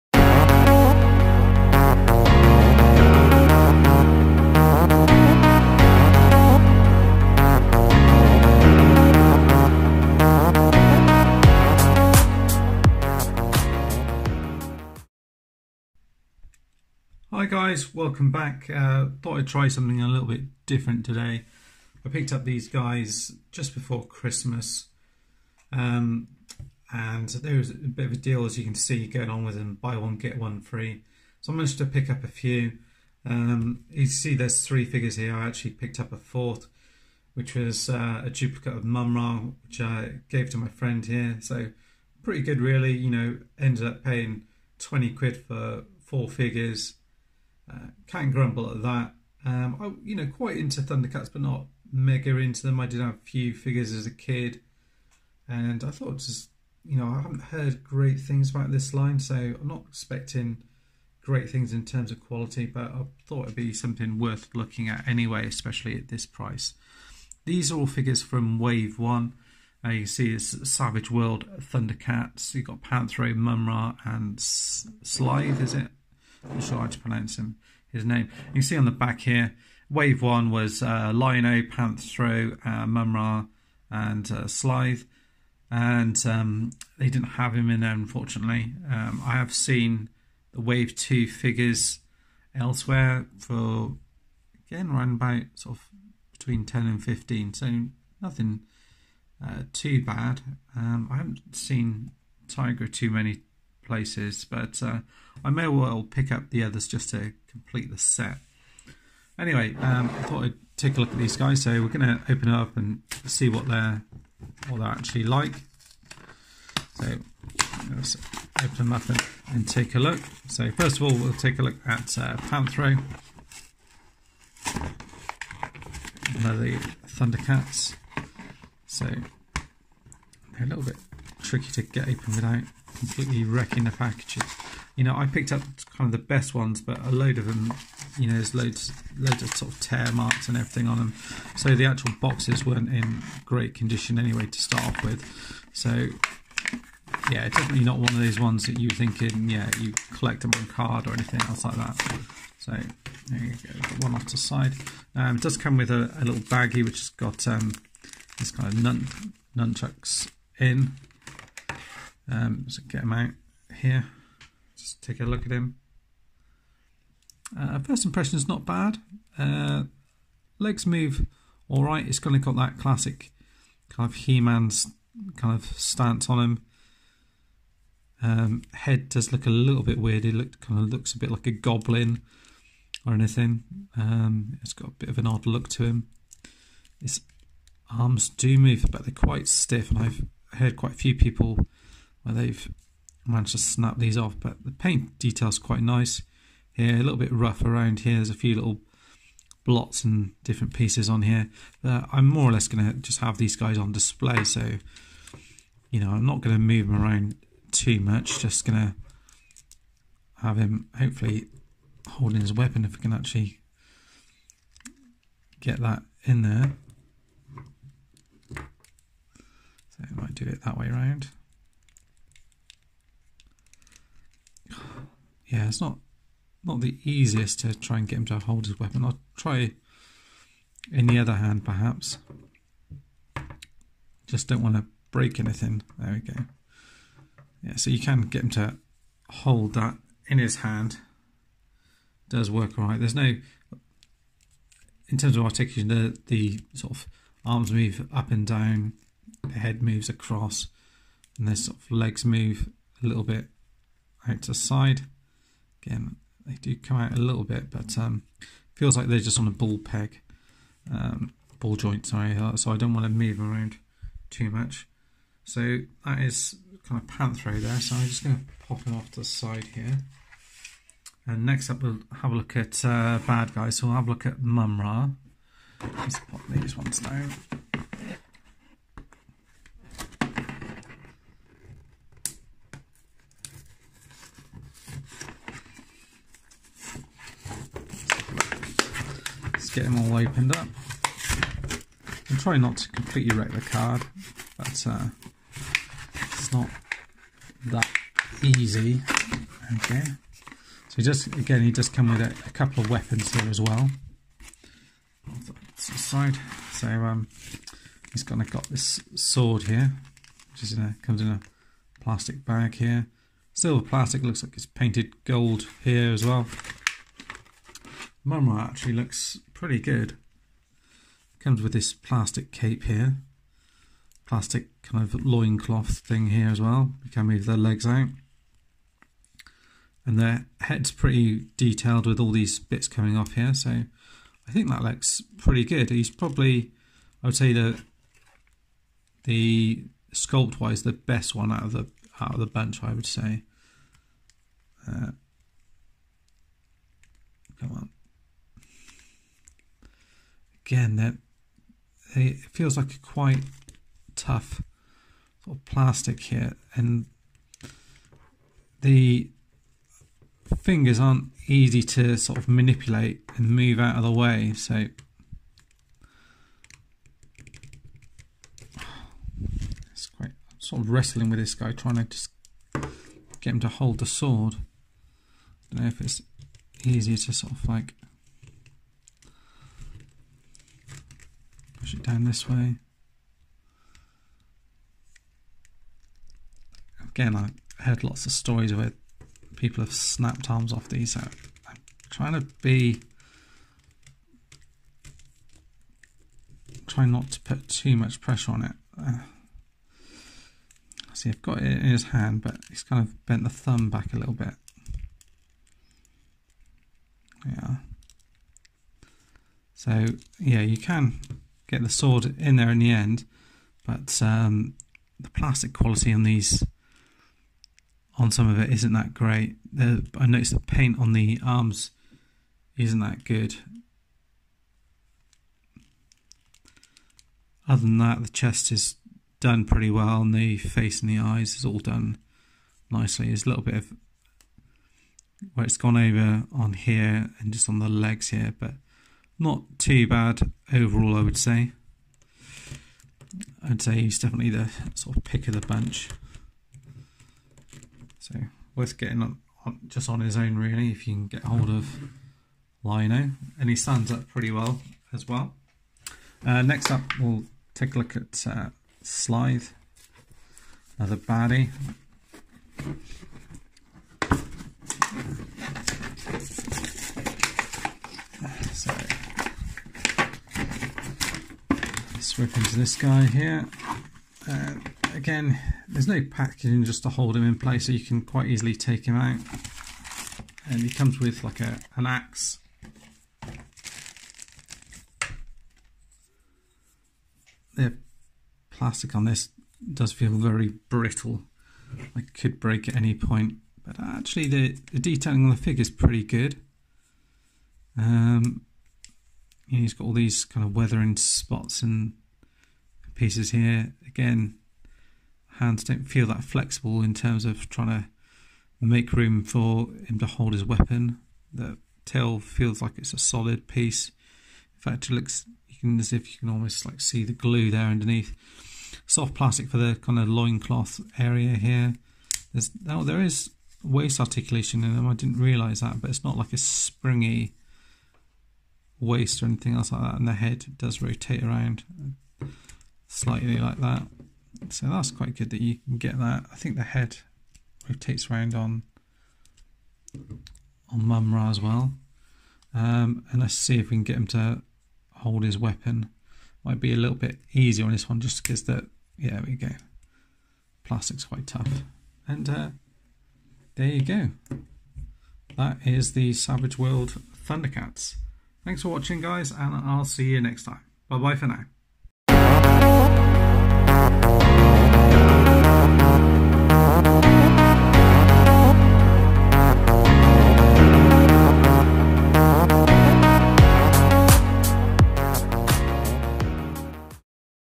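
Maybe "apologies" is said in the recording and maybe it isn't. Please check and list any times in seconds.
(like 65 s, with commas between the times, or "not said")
not said.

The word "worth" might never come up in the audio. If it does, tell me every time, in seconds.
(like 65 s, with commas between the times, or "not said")
64 s, 448 s.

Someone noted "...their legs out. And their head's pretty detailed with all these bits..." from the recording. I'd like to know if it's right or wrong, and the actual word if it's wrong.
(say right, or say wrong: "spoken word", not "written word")
right.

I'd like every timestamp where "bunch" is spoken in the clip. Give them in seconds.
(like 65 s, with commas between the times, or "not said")
342 s, 445 s.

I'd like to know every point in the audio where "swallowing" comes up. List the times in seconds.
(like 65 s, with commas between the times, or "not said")
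not said.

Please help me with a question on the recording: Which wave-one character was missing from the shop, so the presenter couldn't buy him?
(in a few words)
Lion-O.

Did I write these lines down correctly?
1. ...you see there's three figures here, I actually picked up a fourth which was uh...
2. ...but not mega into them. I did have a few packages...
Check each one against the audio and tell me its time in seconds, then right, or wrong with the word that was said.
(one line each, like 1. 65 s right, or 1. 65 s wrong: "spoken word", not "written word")
1. 33 s right
2. 51 s wrong: "figures", not "packages".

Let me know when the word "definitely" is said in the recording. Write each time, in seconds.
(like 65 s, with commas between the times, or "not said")
147 s, 444 s.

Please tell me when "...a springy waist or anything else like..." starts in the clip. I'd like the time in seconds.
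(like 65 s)
526 s.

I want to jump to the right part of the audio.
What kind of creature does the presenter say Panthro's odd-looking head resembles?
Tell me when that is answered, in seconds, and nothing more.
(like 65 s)
181 s.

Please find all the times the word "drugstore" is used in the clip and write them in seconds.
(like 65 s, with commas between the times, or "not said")
not said.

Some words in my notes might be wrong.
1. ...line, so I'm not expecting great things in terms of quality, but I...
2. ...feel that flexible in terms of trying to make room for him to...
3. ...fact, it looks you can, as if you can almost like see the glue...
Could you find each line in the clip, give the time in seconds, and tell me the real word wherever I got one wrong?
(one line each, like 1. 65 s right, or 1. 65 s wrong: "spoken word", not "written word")
1. 58 s right
2. 506 s right
3. 514 s right.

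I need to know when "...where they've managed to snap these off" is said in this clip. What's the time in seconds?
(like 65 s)
192 s.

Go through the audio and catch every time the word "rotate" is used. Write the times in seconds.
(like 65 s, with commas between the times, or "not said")
531 s, 537 s.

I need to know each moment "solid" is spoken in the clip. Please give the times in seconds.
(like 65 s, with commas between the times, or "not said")
513 s.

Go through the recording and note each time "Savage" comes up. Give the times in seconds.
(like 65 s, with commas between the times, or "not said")
70 s, 556 s.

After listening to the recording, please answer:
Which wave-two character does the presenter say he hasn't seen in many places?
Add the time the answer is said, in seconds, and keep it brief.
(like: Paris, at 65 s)
Tygra, at 102 s.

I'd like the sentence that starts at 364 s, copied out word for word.
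So it's quite I'm sort of wrestling with this guy, trying to just get him to hold the sword.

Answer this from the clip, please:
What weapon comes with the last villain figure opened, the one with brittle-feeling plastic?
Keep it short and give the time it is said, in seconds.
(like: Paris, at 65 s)
an axe, at 482 s.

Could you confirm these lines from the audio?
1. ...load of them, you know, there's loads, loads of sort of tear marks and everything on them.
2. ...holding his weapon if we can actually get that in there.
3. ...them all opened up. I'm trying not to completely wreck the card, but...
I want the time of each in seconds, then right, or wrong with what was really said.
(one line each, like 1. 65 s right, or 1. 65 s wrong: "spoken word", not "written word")
1. 137 s right
2. 212 s right
3. 289 s right.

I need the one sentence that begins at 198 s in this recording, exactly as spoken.
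There's a few little blots and different pieces on here.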